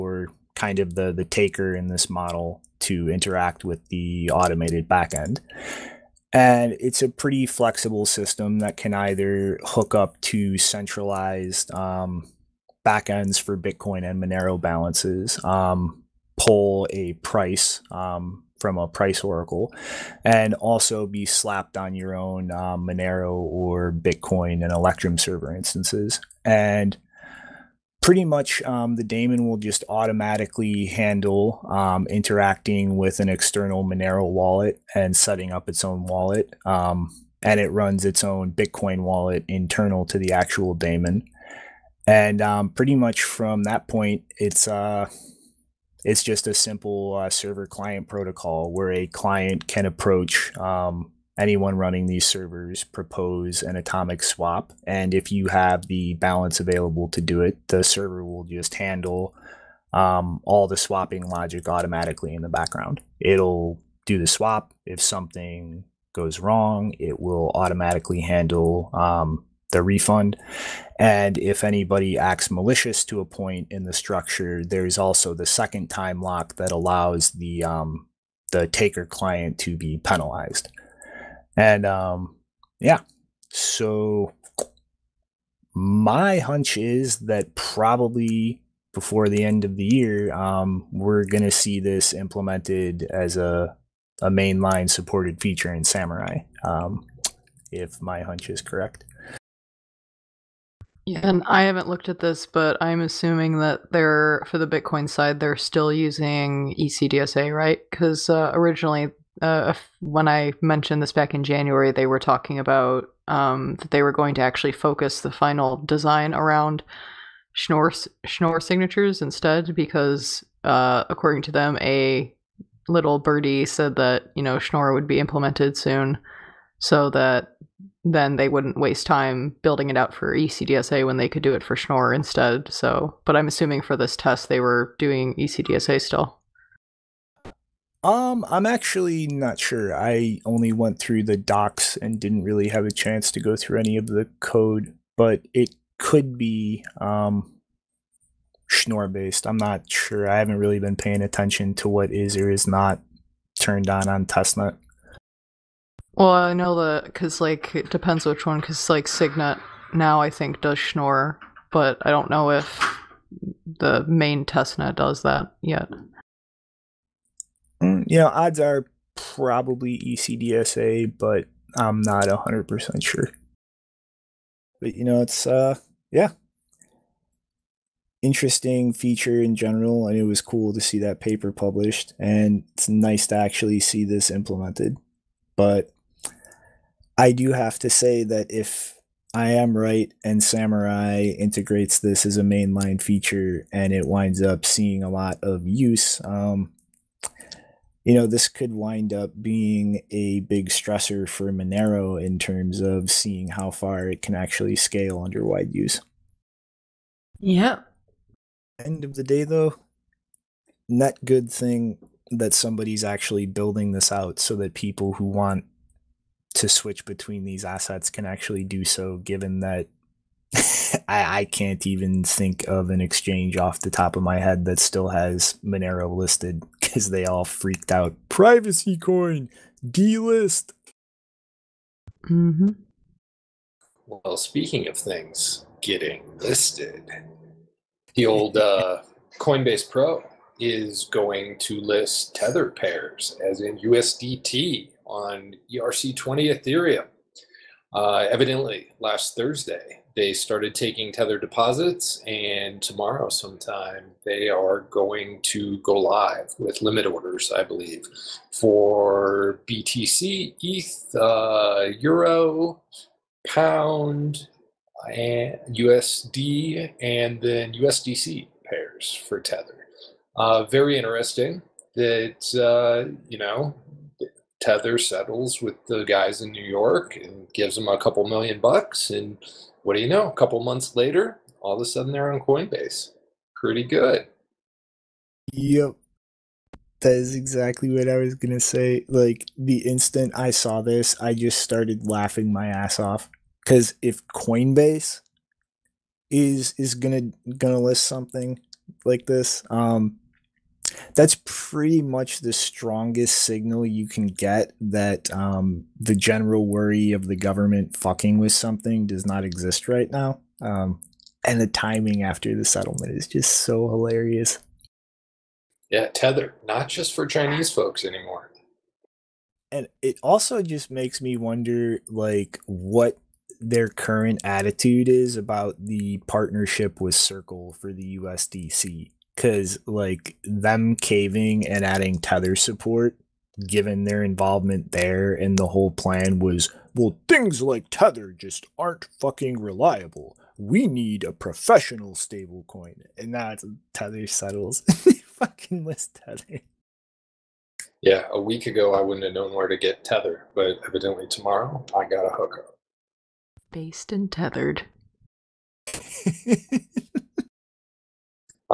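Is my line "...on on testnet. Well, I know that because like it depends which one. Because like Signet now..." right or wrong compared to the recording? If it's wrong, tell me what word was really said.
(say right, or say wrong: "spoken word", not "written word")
right.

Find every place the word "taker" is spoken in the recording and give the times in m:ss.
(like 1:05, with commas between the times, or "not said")
0:01, 1:18.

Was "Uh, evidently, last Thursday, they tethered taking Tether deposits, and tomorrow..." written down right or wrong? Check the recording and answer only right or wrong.
wrong.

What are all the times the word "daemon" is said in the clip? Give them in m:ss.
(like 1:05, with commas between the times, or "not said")
0:29, 0:40.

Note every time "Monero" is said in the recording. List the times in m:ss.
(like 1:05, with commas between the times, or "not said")
0:14, 0:22, 0:33, 3:21, 3:45.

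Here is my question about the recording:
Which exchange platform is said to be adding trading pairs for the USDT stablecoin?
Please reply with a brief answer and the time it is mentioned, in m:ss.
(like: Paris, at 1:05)
Coinbase Pro, at 3:59.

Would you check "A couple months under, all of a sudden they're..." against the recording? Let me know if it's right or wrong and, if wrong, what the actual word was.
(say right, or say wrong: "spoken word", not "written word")
wrong: "later", not "under".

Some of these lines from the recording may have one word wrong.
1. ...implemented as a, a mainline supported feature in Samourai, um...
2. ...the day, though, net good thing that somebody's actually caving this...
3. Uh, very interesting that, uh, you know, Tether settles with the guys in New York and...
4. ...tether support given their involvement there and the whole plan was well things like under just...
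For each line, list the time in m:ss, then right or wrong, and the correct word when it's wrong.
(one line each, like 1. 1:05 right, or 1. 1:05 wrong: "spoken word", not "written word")
1. 1:32 right
2. 3:29 wrong: "building", not "caving"
3. 4:30 right
4. 5:32 wrong: "tether", not "under".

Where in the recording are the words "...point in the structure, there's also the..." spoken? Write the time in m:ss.
1:13.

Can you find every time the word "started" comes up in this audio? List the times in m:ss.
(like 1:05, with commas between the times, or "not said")
4:10, 4:51.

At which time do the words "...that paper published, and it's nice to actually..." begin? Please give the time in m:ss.
3:00.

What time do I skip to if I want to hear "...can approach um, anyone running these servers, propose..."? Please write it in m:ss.
0:49.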